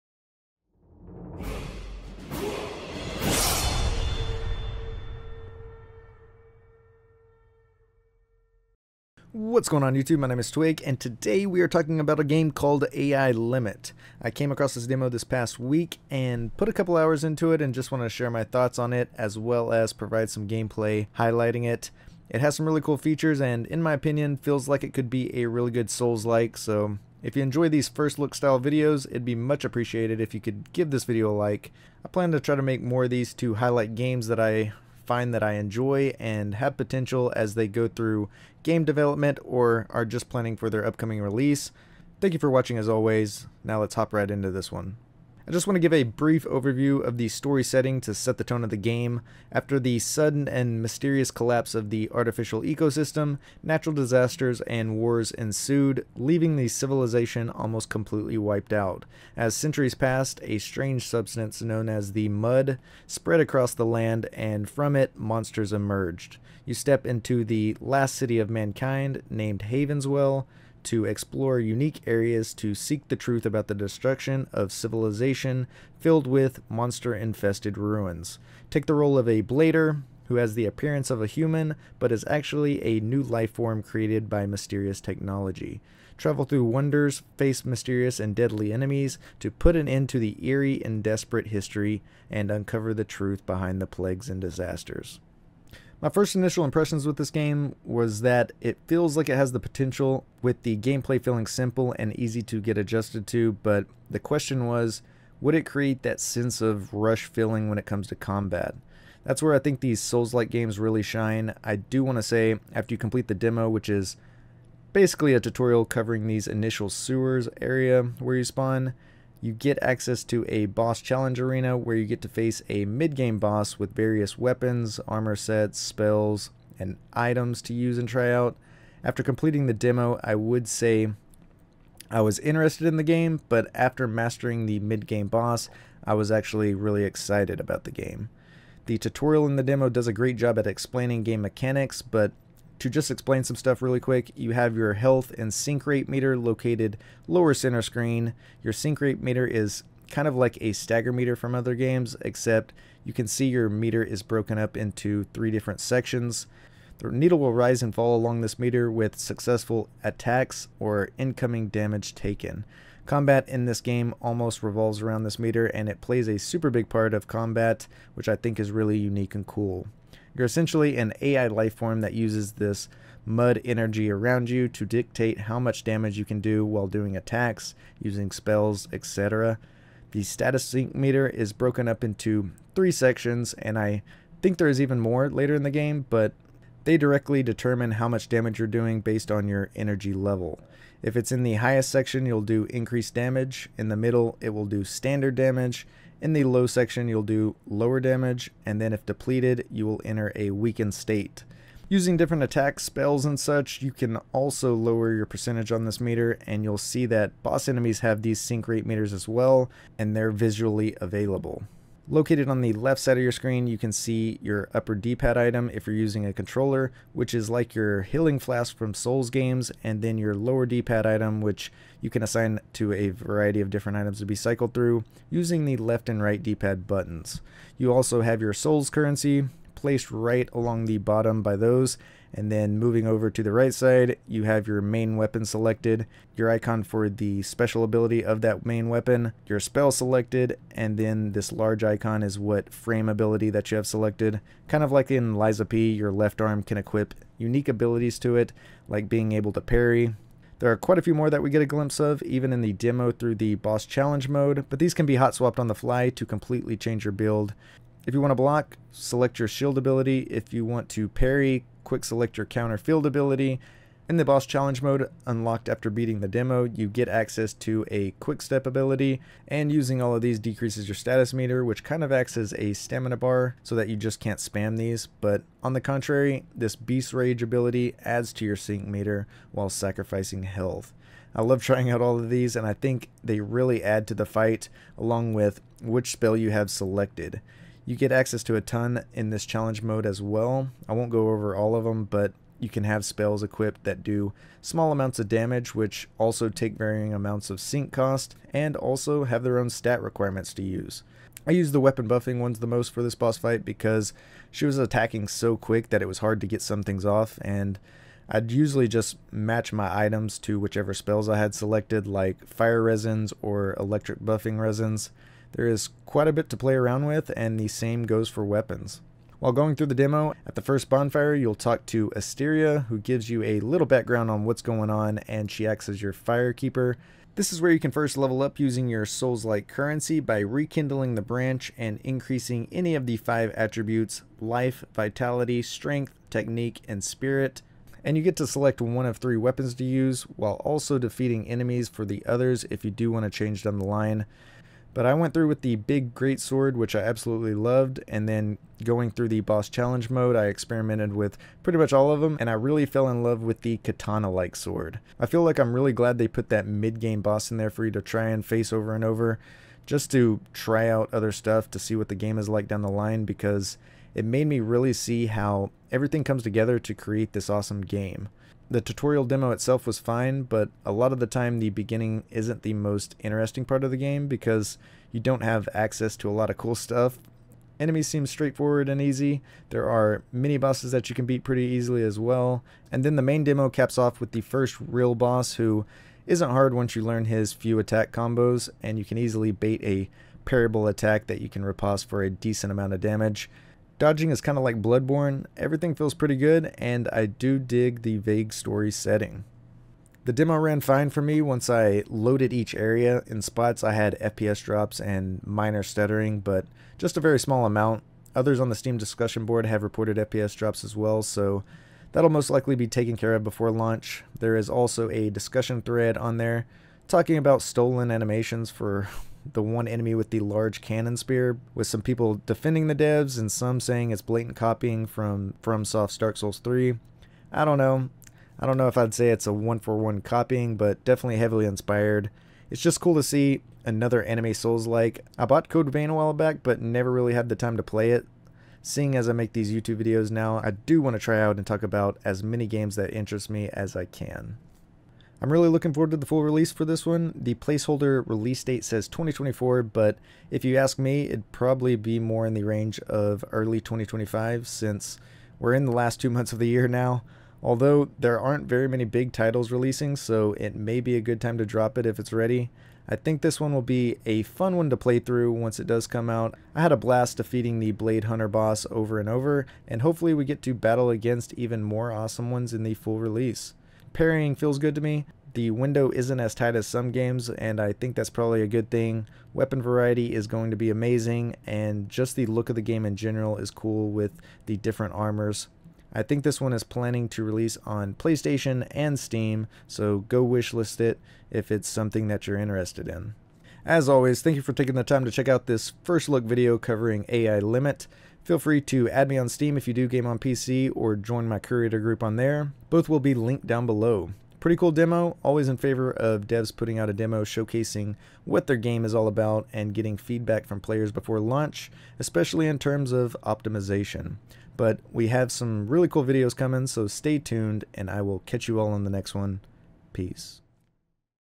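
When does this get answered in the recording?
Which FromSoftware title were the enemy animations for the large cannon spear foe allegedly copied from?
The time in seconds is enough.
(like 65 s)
426 s.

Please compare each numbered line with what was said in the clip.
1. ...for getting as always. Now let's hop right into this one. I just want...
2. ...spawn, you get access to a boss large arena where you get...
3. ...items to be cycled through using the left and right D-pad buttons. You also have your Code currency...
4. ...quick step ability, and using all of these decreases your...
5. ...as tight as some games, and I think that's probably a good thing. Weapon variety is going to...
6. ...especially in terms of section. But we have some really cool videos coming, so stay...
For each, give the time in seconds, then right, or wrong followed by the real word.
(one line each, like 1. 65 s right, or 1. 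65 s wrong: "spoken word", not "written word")
1. 42 s wrong: "watching", not "getting"
2. 118 s wrong: "challenge", not "large"
3. 223 s wrong: "Souls", not "Code"
4. 268 s right
5. 476 s right
6. 512 s wrong: "optimization", not "section".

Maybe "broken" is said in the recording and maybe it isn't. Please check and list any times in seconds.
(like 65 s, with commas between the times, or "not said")
154 s, 181 s.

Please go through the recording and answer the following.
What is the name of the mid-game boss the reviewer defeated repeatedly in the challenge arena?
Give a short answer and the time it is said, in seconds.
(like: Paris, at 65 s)
Blade Hunter, at 467 s.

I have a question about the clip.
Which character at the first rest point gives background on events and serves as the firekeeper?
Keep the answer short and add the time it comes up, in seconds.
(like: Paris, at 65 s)
Asteria, at 322 s.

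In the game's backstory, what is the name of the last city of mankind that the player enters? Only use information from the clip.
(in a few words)
Havenswell.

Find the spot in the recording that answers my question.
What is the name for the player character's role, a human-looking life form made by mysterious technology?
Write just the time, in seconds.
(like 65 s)
79 s.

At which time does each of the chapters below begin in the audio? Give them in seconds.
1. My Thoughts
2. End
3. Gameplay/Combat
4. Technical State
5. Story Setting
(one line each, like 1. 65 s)
1. 445 s
2. 493 s
3. 95 s
4. 400 s
5. 45 s.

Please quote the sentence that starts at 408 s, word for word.
Others on the Steam discussion board have reported FPS drops as well, so that'll most likely be taken care of before launch.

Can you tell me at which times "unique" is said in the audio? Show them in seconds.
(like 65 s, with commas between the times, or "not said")
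71 s, 168 s, 247 s.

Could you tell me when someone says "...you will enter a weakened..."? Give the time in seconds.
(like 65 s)
199 s.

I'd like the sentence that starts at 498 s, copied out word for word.
Feel free to add me on Steam if you do game on PC or join my curator group on there.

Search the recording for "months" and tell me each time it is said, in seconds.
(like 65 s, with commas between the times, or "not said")
456 s.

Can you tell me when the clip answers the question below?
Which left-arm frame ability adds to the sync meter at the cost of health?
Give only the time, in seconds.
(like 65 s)
276 s.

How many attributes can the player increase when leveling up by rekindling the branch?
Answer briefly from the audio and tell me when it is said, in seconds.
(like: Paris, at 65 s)
5, at 333 s.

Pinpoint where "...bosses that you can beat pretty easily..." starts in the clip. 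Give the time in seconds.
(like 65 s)
380 s.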